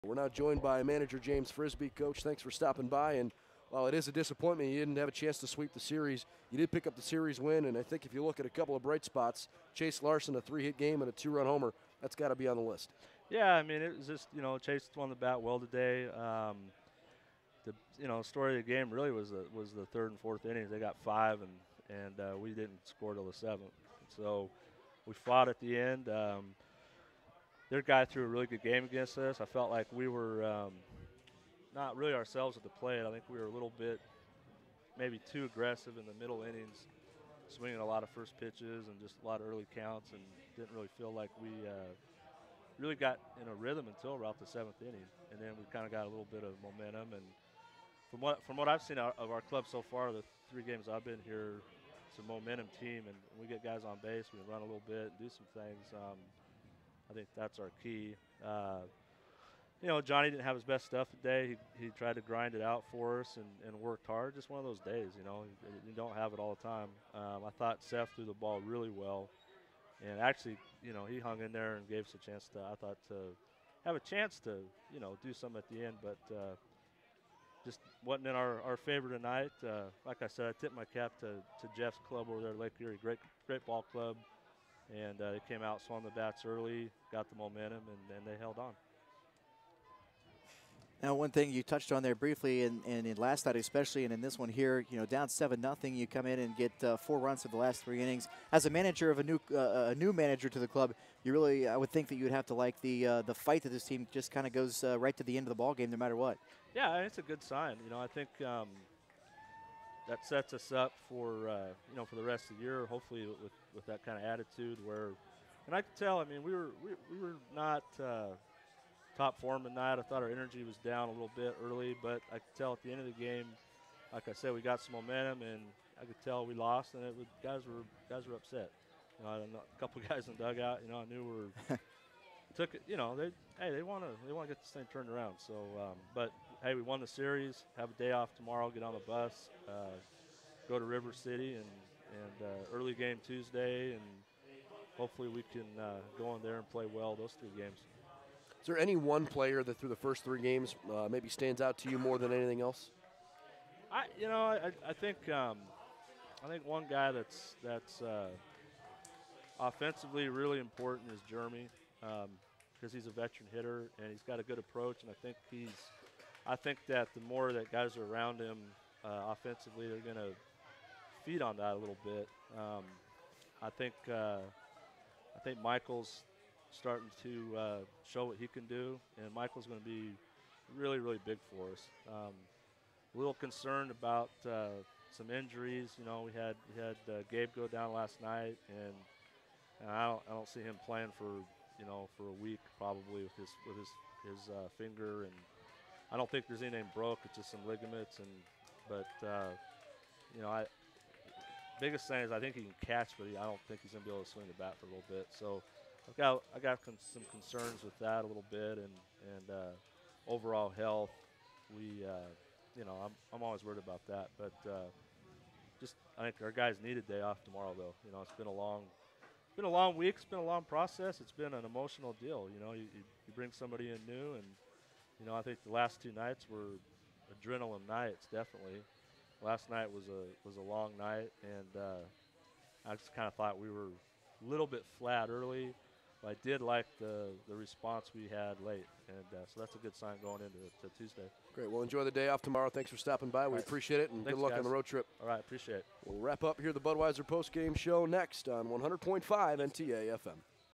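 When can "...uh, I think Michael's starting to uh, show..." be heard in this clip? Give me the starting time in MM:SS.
02:54.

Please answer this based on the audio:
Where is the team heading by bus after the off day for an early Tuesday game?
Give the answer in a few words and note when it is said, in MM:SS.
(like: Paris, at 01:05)
River City, at 02:20.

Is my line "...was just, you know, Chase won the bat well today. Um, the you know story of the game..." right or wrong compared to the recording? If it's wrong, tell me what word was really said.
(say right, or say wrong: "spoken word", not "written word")
right.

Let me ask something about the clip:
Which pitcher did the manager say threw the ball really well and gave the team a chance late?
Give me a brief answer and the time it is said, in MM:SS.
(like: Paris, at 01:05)
Seth, at 01:07.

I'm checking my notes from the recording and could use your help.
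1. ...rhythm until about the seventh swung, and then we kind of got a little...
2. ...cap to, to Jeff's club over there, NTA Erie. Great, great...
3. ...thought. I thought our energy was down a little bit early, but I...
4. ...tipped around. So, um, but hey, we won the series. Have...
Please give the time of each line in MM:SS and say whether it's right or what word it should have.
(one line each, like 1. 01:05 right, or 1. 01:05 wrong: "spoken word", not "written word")
1. 00:43 wrong: "inning", not "swung"
2. 01:20 wrong: "Lake", not "NTA"
3. 01:59 wrong: "tonight", not "thought"
4. 02:14 wrong: "turned", not "tipped".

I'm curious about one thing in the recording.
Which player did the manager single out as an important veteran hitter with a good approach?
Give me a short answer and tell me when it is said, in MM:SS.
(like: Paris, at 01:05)
Jeremy, at 02:41.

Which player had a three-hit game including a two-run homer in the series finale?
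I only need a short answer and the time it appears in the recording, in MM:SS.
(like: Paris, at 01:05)
Chase Larson, at 00:09.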